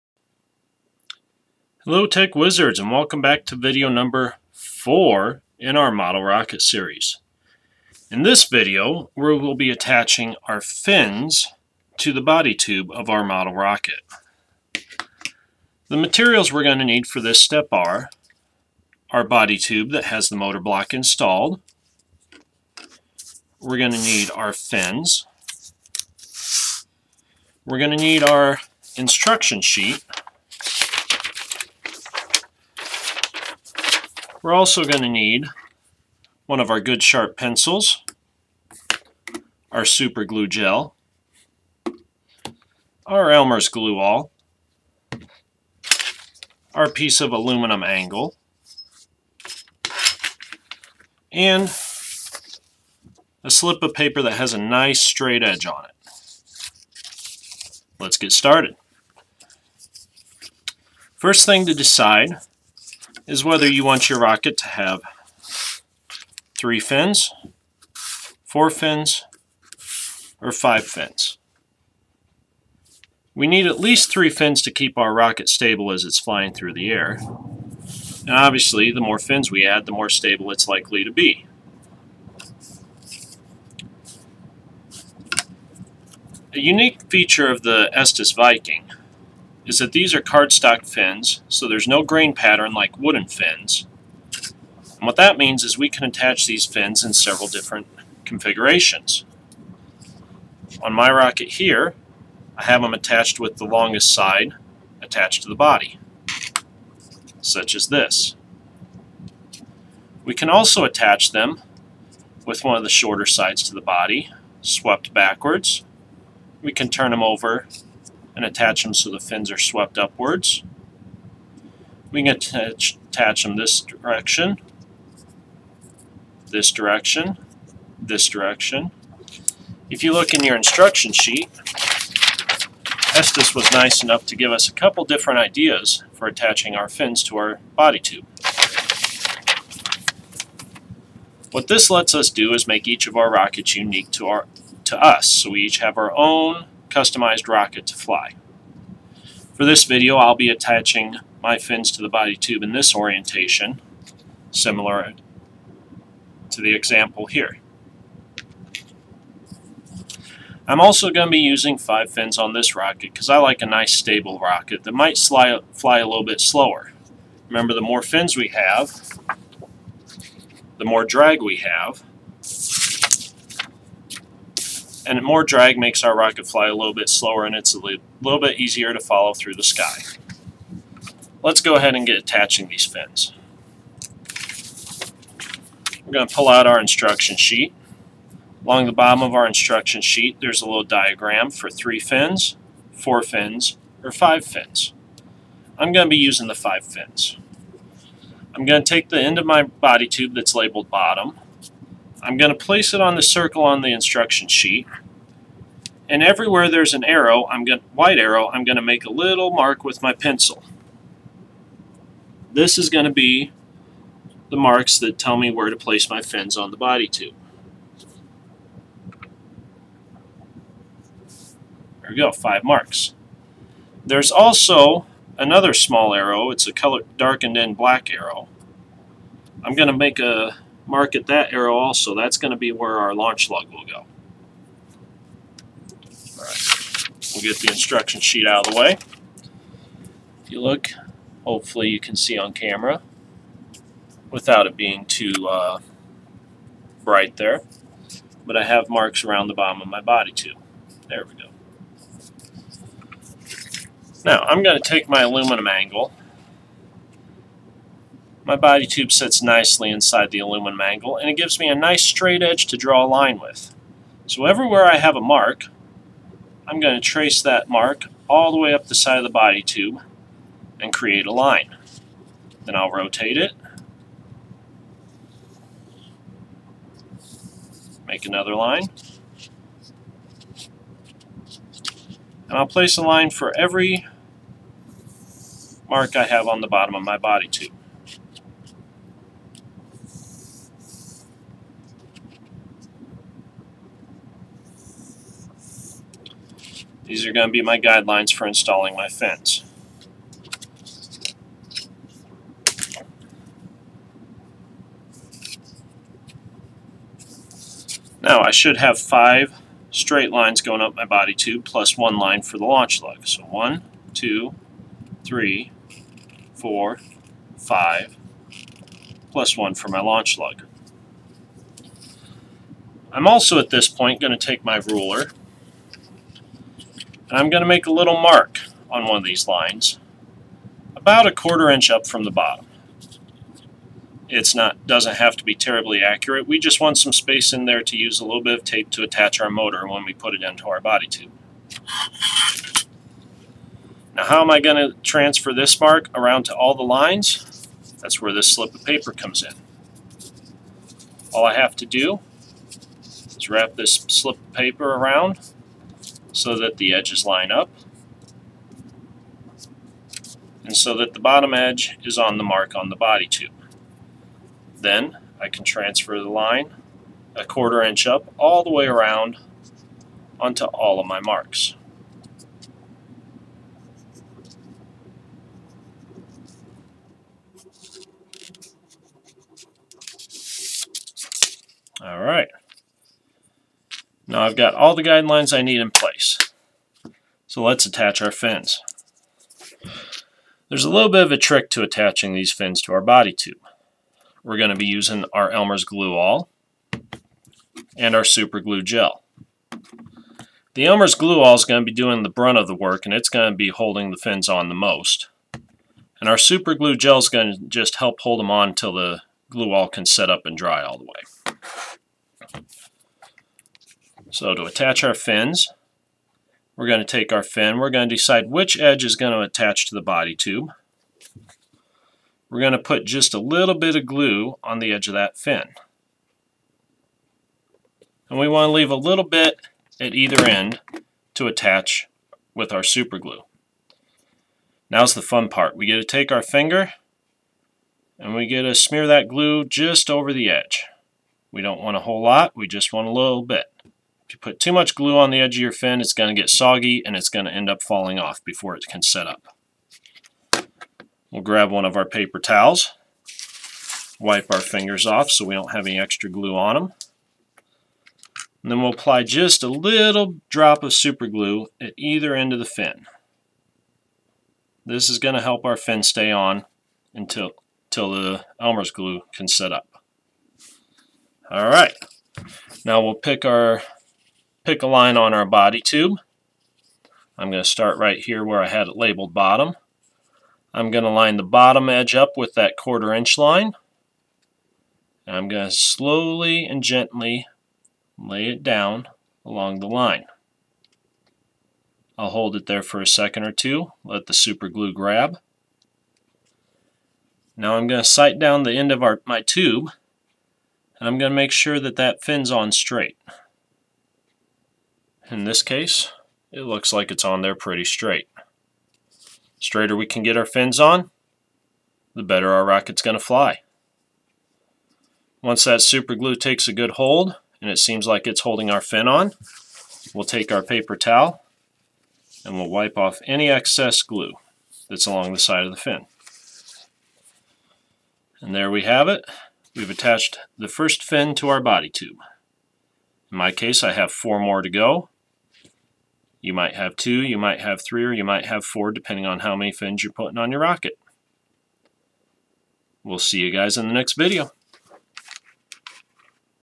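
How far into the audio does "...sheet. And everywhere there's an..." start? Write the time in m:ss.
3:24.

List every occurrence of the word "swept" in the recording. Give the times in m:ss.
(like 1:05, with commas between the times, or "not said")
1:54, 1:59.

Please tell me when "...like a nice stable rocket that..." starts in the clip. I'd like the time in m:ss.
2:43.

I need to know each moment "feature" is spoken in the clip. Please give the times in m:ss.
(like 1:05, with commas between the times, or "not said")
1:27.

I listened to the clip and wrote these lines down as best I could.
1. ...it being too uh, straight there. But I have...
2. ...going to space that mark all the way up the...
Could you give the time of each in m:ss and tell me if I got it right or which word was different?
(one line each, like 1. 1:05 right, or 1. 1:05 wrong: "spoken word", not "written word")
1. 4:04 wrong: "bright", not "straight"
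2. 4:26 wrong: "trace", not "space".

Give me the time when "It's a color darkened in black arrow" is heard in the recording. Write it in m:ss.
3:46.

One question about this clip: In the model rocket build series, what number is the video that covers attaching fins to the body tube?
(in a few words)
4.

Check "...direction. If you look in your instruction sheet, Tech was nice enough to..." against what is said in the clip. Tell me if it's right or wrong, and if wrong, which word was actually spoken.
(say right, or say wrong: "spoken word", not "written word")
wrong: "Estes", not "Tech".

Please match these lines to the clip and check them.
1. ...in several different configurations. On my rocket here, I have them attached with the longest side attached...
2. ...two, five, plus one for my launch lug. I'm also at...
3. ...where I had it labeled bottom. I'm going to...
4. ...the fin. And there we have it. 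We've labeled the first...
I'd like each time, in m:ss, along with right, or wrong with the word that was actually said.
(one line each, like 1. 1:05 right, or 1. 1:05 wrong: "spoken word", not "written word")
1. 1:37 right
2. 5:16 wrong: "four", not "two"
3. 7:58 right
4. 8:45 wrong: "attached", not "labeled".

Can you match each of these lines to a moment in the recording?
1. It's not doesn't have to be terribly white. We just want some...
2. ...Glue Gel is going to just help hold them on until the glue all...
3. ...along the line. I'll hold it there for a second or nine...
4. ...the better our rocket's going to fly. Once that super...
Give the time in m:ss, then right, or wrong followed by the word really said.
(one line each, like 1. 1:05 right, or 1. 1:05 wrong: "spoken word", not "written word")
1. 5:34 wrong: "accurate", not "white"
2. 6:46 right
3. 8:09 wrong: "two", not "nine"
4. 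8:32 right.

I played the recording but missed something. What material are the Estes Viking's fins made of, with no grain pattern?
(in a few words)
Cardstock.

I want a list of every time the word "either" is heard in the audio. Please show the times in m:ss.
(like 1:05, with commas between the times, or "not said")
7:10, 7:41.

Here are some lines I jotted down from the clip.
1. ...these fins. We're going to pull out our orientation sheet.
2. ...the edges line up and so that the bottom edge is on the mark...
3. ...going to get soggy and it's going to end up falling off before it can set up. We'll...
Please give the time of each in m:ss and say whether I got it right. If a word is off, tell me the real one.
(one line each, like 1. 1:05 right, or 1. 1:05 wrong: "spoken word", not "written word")
1. 3:02 wrong: "instruction", not "orientation"
2. 5:56 right
3. 7:26 right.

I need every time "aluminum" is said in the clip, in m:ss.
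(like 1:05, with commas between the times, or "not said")
0:47, 4:15, 4:20.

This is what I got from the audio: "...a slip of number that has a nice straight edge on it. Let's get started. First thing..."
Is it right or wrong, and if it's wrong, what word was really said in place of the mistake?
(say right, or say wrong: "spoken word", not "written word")
wrong: "paper", not "number".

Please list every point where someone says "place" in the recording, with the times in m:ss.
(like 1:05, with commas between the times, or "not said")
3:22, 3:35, 4:42, 6:25.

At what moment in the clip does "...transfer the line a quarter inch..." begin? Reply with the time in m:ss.
6:05.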